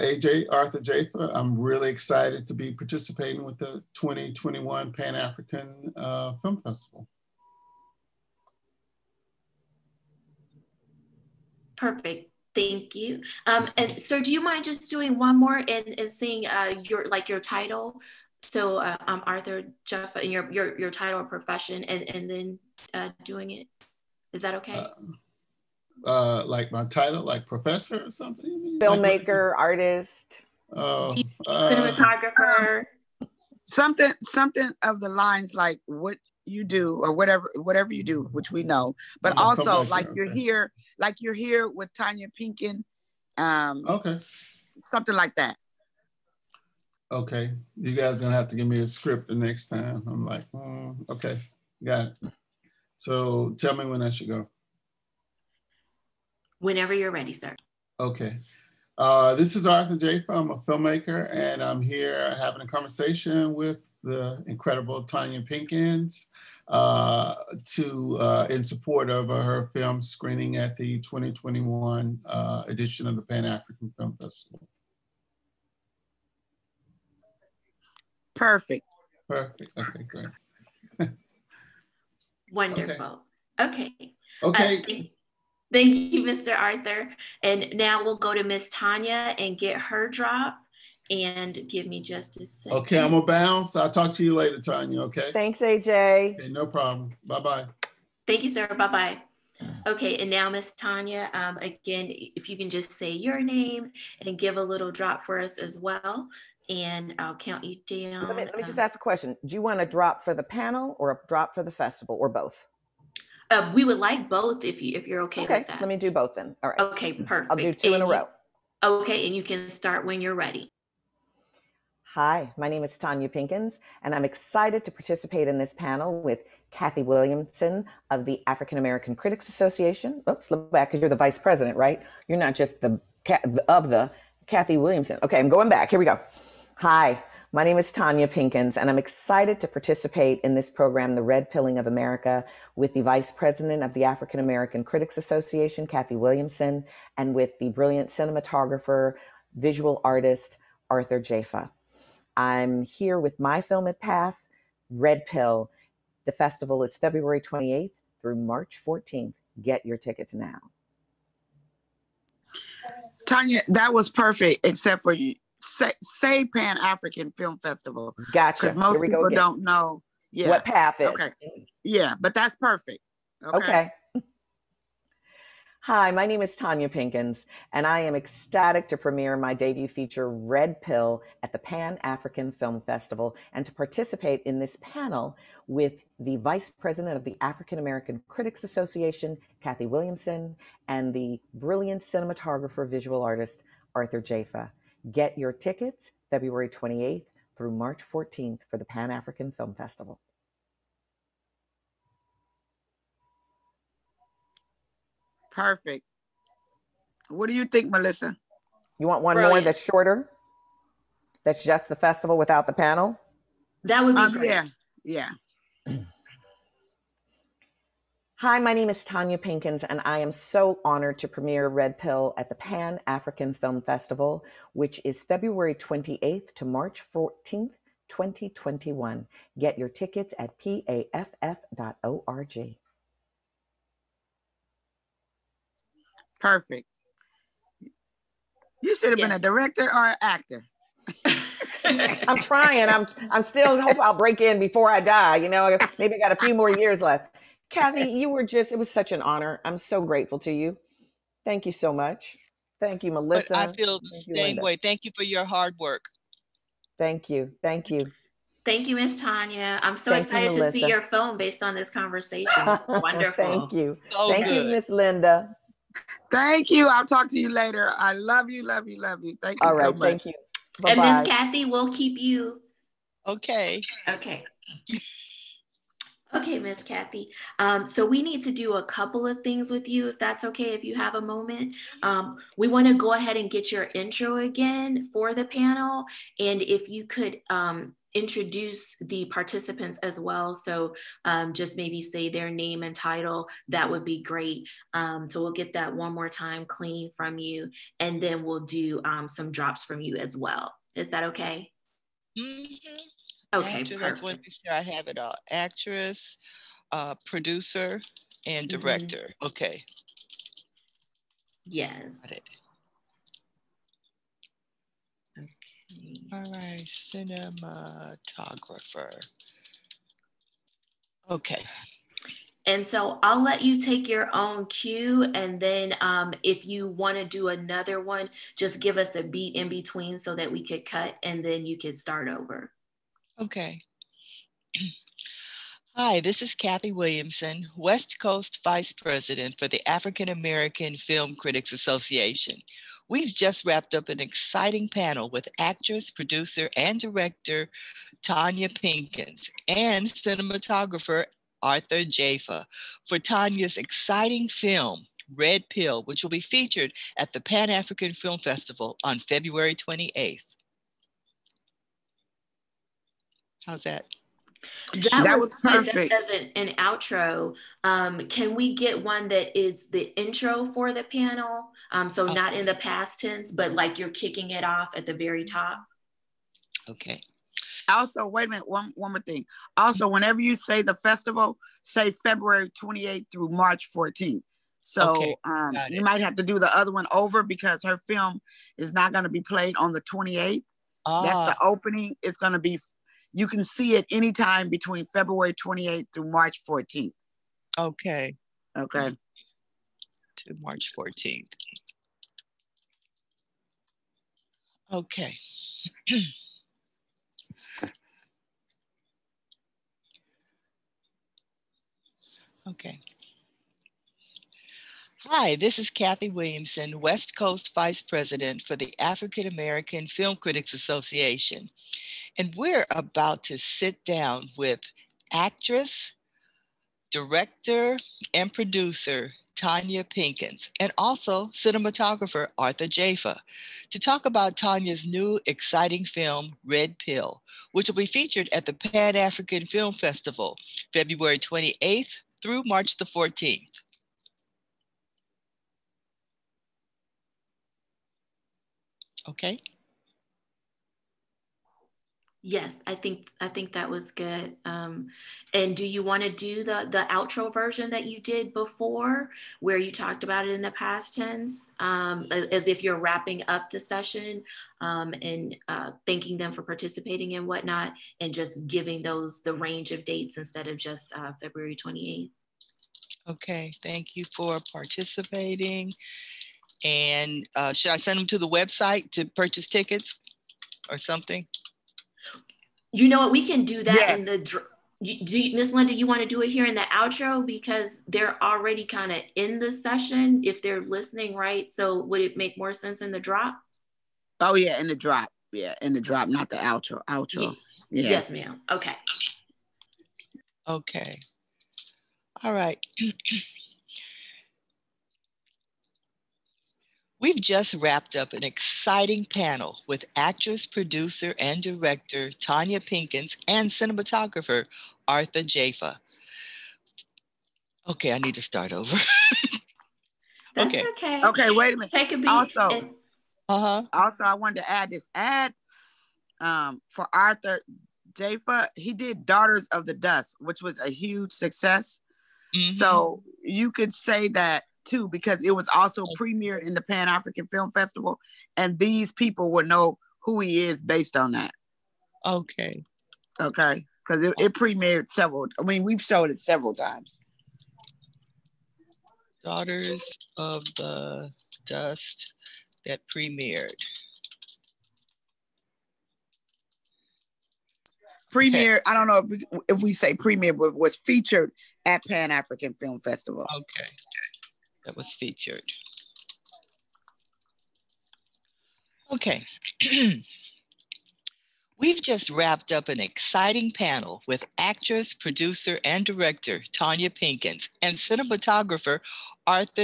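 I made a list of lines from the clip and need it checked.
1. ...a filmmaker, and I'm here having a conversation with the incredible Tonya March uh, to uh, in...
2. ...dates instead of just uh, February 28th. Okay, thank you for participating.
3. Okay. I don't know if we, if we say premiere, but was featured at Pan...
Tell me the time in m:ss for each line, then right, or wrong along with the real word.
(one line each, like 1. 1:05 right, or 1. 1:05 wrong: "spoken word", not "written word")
1. 1:00 wrong: "Pinkins", not "March"
2. 7:50 right
3. 9:18 right.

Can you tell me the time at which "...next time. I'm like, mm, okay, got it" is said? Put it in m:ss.
0:49.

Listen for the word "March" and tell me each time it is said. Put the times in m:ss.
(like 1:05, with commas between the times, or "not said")
2:38, 3:17, 3:46, 6:23, 6:36, 6:40, 7:22.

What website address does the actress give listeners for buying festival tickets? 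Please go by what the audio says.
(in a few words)
paff.org.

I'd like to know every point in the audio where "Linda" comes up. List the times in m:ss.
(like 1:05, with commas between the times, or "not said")
4:24, 8:05.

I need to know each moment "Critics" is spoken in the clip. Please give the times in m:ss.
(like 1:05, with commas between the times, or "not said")
2:09, 2:24, 3:08, 5:41, 7:00.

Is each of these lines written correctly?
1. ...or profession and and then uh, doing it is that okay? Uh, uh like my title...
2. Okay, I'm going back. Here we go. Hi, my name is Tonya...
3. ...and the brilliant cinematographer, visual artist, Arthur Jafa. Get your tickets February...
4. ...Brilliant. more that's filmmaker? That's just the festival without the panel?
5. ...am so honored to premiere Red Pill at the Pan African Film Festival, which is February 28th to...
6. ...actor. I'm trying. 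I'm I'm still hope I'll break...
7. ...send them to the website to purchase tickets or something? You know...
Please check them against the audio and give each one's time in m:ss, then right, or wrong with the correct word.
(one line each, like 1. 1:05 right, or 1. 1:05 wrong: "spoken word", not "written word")
1. 0:21 right
2. 2:15 right
3. 3:10 right
4. 3:29 wrong: "shorter", not "filmmaker"
5. 3:40 right
6. 4:00 right
7. 7:57 right.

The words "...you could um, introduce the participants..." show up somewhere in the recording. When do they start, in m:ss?
4:46.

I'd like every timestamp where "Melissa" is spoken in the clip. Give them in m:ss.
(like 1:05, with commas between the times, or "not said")
3:27, 4:13.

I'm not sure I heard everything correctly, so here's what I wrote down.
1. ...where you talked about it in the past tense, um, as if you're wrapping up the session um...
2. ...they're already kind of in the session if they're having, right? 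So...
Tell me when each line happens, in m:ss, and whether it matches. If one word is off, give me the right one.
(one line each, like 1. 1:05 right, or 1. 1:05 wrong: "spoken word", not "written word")
1. 7:39 right
2. 8:08 wrong: "listening", not "having".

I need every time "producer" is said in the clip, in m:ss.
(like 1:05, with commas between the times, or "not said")
5:07, 5:46, 7:08, 8:30, 9:35.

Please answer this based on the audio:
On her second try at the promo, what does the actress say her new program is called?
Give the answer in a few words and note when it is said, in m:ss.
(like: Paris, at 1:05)
The Red Pilling of America, at 2:21.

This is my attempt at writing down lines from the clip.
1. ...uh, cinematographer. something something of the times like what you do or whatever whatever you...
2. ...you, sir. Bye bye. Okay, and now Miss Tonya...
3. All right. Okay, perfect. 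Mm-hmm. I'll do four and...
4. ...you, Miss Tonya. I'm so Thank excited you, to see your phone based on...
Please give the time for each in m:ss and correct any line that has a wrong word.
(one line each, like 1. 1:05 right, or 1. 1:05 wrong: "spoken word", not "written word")
1. 0:31 wrong: "lines", not "times"
2. 1:38 right
3. 1:56 wrong: "two", not "four"
4. 4:18 right.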